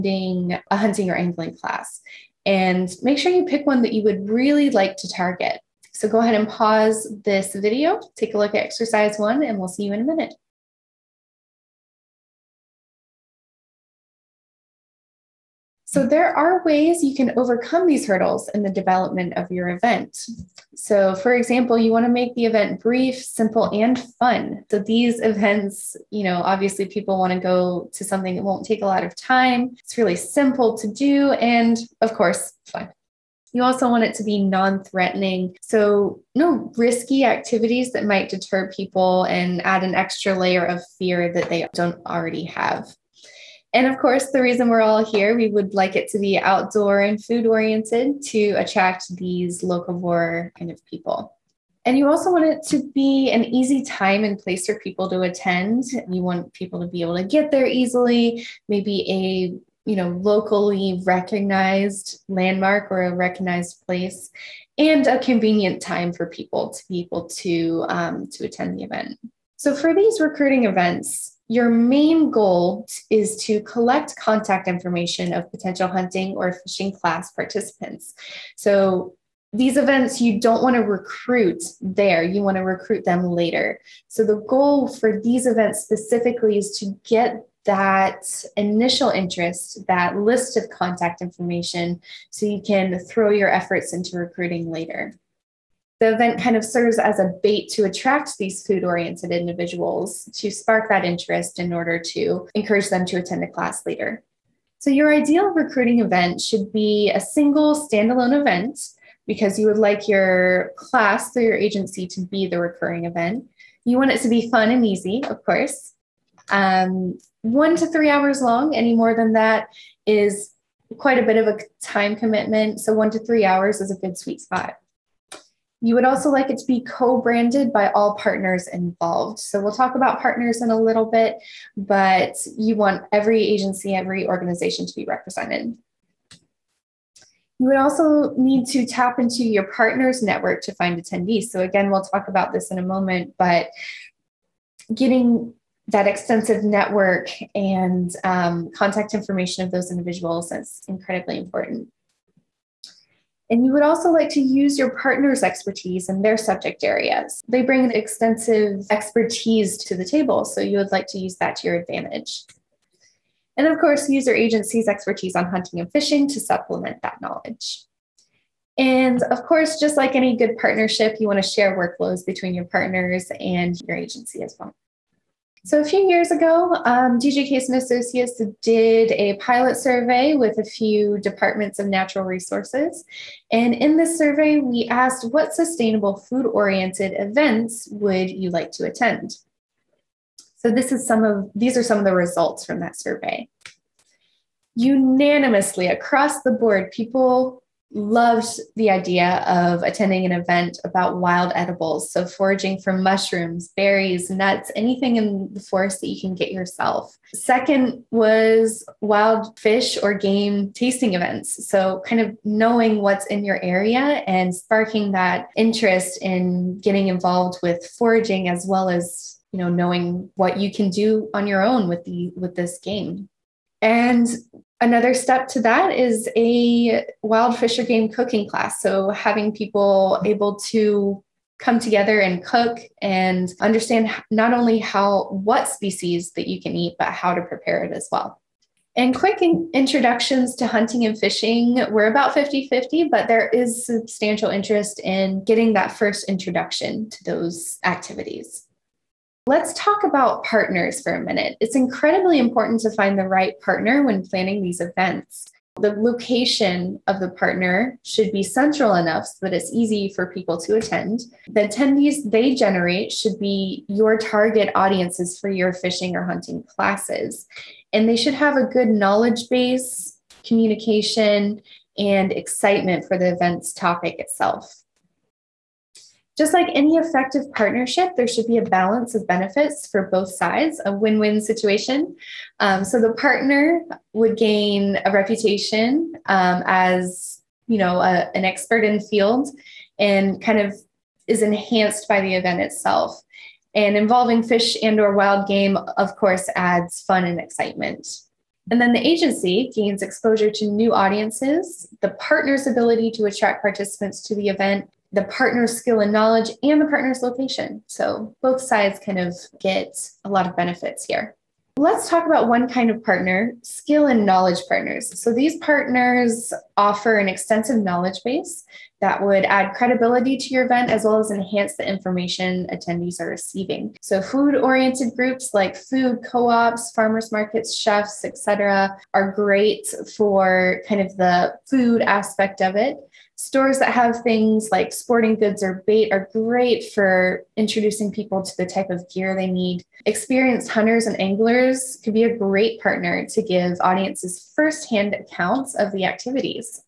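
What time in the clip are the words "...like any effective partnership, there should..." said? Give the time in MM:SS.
04:36.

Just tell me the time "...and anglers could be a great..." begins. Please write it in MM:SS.
05:41.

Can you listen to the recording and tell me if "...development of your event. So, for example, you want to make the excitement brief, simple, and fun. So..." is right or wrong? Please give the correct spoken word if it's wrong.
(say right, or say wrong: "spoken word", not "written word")
wrong: "event", not "excitement".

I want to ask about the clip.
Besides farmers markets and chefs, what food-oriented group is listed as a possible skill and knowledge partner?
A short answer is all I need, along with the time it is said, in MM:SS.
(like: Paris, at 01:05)
Food co-ops, at 05:25.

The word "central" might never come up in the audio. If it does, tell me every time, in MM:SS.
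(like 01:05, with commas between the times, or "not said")
04:18.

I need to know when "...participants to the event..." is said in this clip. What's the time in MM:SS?
05:03.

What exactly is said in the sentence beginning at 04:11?
It's incredibly important to find the right partner when planning these events.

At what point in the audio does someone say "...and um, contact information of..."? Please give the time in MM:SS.
02:27.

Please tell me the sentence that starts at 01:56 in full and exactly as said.
Um, one to three hours long, any more than that is quite a bit of a time commitment.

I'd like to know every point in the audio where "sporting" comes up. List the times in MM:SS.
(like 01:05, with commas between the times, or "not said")
05:34.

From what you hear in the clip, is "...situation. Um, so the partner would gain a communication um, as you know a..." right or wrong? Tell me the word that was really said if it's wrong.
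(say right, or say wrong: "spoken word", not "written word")
wrong: "reputation", not "communication".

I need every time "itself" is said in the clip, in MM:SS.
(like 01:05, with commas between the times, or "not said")
04:34, 04:52.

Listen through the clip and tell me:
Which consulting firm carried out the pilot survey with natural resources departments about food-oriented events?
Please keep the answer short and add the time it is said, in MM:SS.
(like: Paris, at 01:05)
DJ Case and Associates, at 02:57.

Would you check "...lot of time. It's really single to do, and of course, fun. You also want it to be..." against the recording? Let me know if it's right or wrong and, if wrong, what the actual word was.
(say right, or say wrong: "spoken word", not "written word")
wrong: "simple", not "single".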